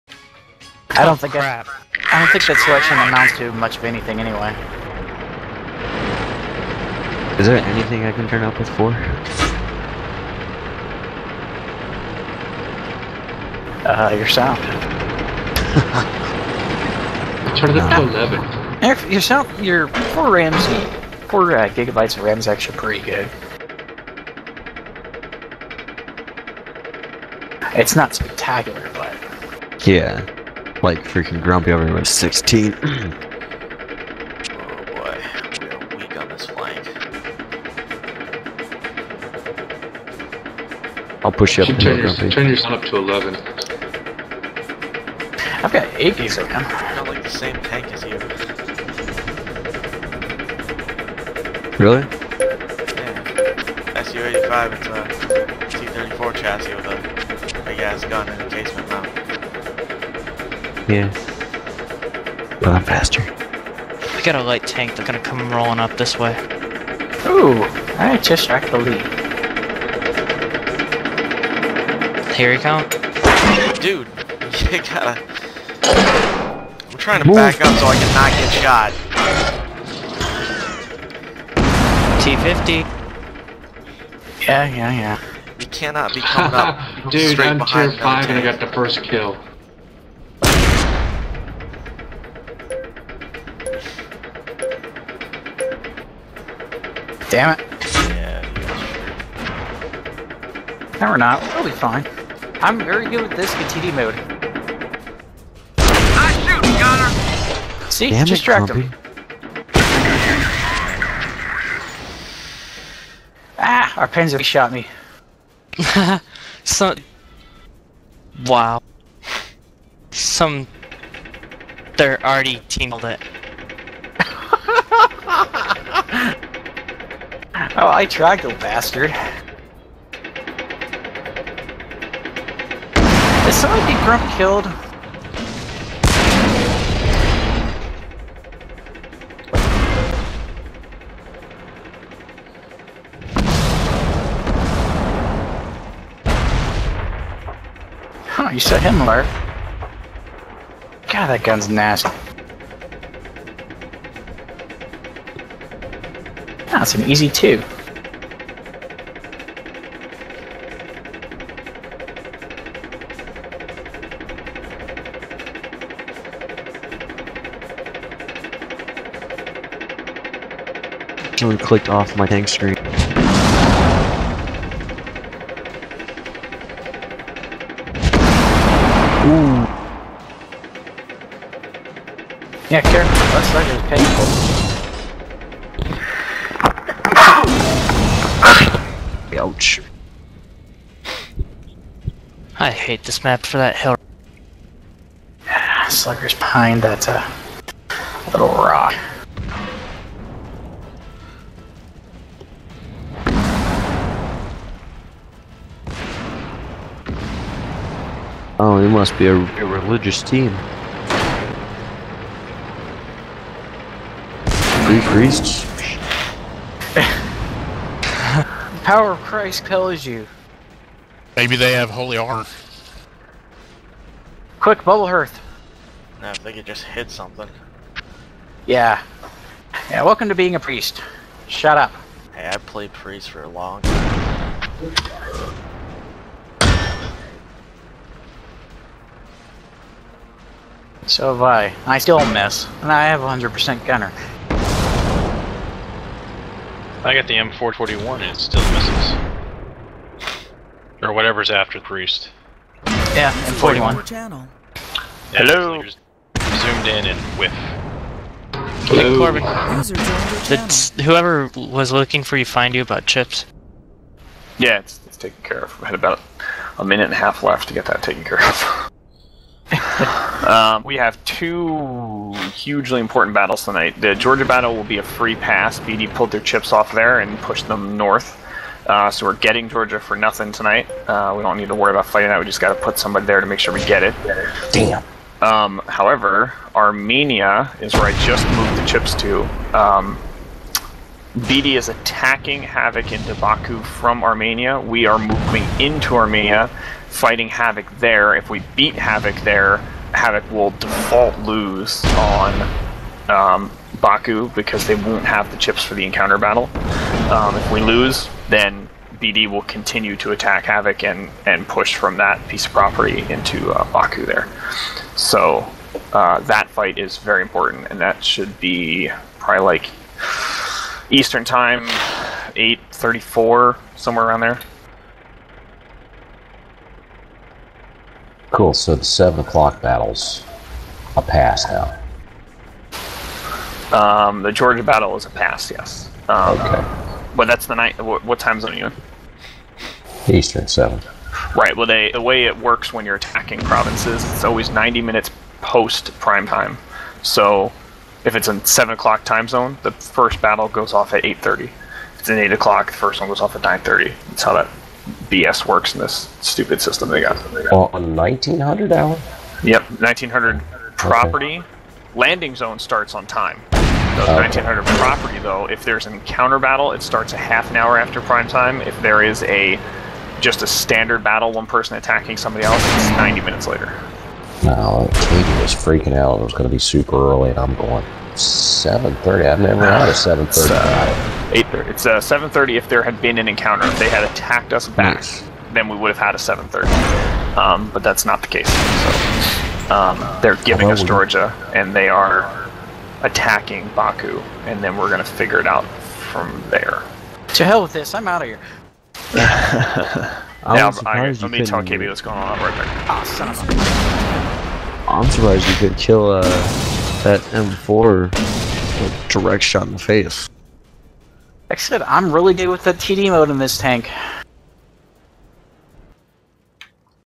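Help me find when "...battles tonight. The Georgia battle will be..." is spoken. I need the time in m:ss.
4:33.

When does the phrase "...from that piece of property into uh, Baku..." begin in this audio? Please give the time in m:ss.
5:11.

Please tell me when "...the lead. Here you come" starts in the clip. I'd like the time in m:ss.
1:08.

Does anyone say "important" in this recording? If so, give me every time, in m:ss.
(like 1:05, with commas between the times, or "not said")
4:32, 5:17.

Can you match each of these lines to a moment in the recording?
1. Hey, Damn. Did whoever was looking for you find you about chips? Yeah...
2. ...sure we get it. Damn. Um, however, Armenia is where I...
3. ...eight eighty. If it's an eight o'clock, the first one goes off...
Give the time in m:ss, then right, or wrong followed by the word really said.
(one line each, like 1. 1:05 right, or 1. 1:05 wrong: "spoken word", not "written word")
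1. 4:19 wrong: "Corbin", not "Damn"
2. 4:43 right
3. 5:51 wrong: "thirty", not "eighty".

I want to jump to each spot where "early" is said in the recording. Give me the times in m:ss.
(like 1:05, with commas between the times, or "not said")
6:17.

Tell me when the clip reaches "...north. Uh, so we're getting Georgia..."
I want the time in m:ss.
4:37.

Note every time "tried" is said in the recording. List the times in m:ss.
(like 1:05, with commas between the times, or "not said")
2:08.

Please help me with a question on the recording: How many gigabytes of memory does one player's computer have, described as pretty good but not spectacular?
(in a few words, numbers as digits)
4.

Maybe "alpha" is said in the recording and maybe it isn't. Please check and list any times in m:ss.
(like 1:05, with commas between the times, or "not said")
not said.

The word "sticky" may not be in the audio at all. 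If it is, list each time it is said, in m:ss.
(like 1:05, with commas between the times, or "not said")
not said.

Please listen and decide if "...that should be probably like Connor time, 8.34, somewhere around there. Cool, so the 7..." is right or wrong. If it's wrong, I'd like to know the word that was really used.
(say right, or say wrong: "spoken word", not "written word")
wrong: "Eastern", not "Connor".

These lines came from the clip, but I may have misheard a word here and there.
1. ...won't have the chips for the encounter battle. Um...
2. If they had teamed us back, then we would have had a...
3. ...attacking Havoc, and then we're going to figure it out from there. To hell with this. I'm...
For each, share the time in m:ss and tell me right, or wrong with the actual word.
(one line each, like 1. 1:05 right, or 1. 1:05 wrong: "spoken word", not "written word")
1. 5:04 right
2. 6:23 wrong: "attacked", not "teamed"
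3. 6:33 wrong: "Baku", not "Havoc".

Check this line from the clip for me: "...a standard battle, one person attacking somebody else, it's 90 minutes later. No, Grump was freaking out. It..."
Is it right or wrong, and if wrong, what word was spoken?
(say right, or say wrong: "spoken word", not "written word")
wrong: "Katie", not "Grump".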